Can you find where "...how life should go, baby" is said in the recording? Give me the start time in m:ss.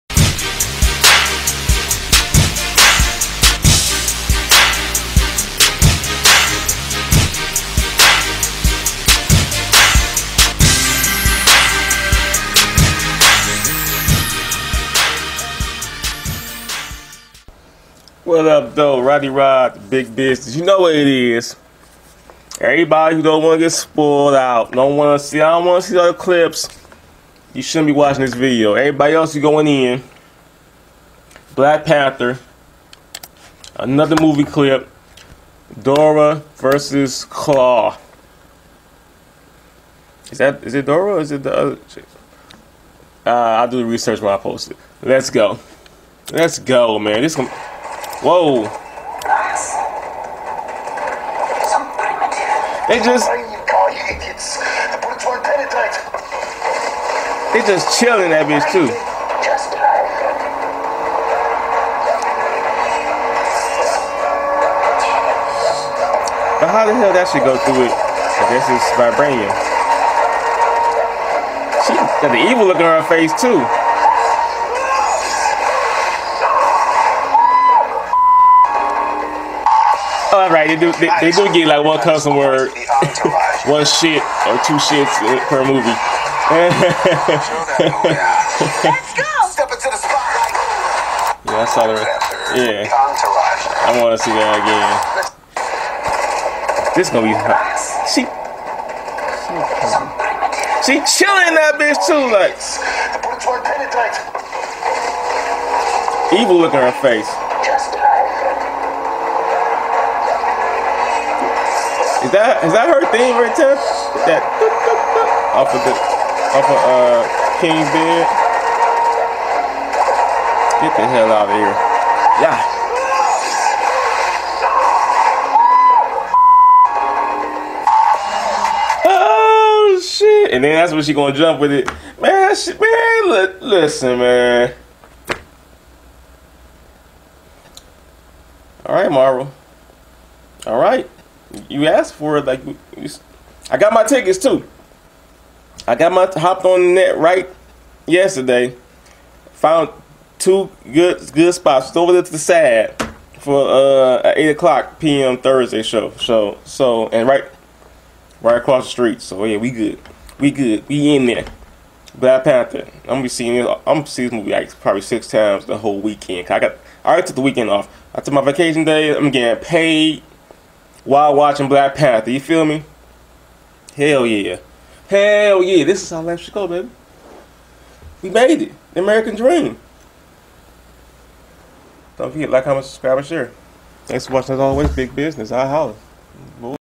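2:56.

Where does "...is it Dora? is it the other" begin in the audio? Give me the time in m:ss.
0:40.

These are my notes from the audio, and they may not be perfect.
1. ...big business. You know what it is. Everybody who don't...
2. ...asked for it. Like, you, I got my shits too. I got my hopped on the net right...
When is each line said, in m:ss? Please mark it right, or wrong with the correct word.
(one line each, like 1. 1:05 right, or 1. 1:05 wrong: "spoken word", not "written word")
1. 0:19 right
2. 2:21 wrong: "tickets", not "shits".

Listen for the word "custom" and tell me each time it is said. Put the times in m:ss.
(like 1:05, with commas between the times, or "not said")
1:22.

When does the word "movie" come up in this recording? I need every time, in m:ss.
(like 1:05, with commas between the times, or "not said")
0:34, 1:25, 2:44.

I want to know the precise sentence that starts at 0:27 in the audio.
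You shouldn't be watching this video.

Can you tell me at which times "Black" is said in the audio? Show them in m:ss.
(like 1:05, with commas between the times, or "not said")
0:31, 2:42, 2:51.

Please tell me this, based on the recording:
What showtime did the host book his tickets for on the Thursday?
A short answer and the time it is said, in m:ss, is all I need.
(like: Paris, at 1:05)
8 p.m., at 2:34.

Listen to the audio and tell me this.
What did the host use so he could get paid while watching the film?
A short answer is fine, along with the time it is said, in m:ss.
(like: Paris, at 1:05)
vacation day, at 2:48.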